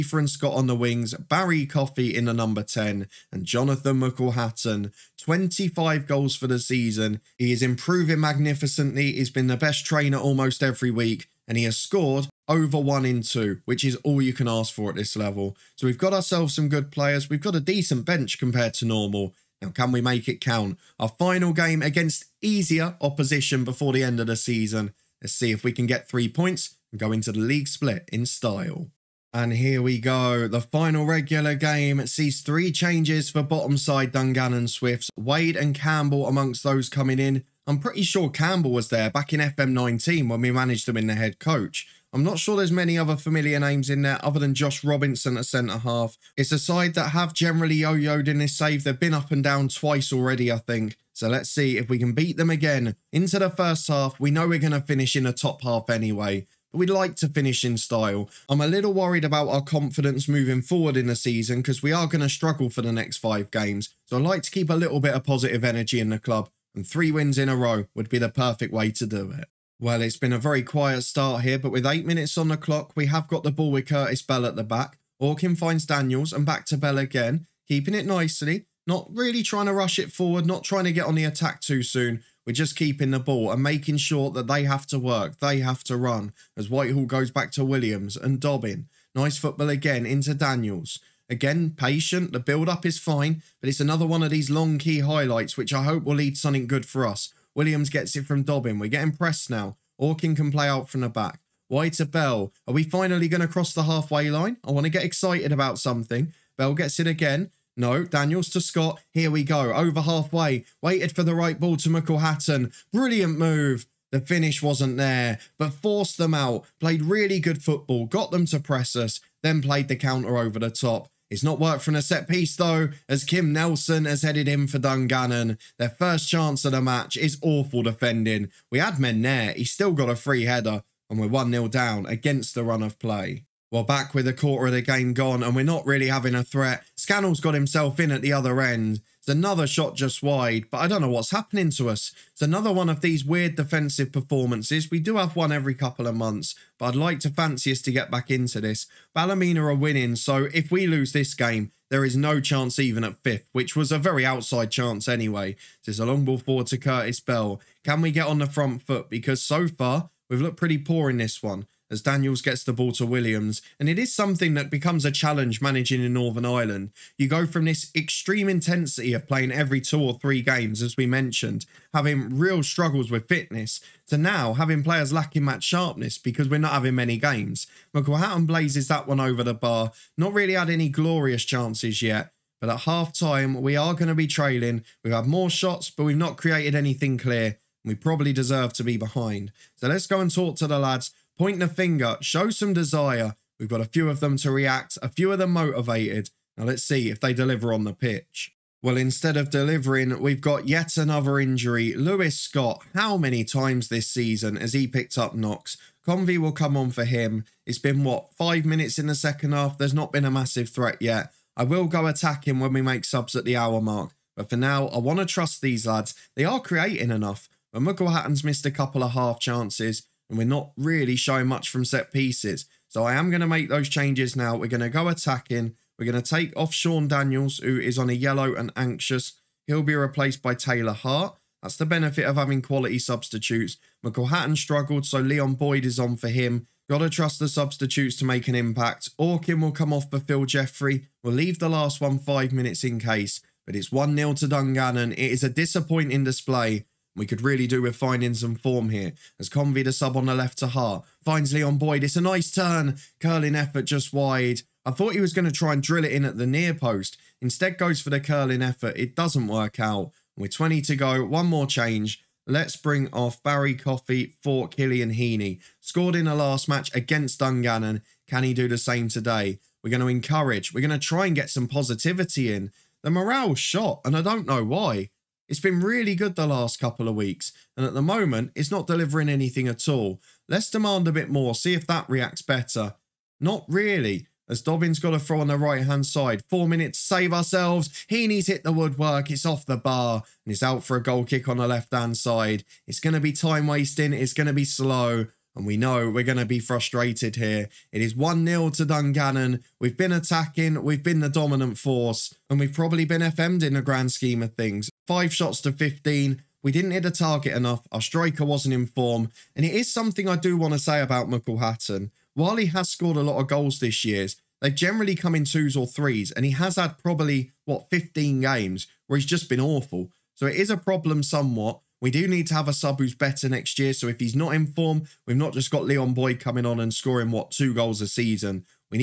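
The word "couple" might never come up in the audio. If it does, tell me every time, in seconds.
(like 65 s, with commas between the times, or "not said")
145 s, 218 s, 276 s.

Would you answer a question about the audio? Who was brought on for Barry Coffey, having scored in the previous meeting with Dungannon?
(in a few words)
Killian Heaney.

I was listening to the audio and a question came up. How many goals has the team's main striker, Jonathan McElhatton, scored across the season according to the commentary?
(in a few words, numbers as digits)
25.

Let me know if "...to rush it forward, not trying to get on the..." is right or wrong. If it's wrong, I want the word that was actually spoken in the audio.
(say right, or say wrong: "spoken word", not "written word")
right.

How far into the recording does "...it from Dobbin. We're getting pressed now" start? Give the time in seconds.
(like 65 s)
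98 s.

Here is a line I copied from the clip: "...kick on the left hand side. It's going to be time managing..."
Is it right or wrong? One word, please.
wrong.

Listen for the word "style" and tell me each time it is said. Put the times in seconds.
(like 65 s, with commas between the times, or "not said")
28 s, 57 s.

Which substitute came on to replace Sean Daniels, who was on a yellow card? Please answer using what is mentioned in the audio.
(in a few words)
Taylor Hart.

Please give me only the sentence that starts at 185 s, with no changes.
We've had more shots, but we've not created anything clear.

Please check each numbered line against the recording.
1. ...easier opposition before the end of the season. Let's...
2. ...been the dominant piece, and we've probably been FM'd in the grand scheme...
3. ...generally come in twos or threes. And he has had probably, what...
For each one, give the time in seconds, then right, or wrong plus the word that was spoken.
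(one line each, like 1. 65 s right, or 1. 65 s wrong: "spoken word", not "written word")
1. 22 s right
2. 301 s wrong: "force", not "piece"
3. 314 s right.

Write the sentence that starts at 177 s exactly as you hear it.
McCall blazes that one over the bar, not really had any glorious chances yet.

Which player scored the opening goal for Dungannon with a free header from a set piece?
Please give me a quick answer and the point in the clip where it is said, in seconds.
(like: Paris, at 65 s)
Kim Nelson, at 123 s.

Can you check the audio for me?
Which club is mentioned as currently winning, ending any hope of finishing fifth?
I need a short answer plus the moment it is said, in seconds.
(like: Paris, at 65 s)
Ballymena, at 149 s.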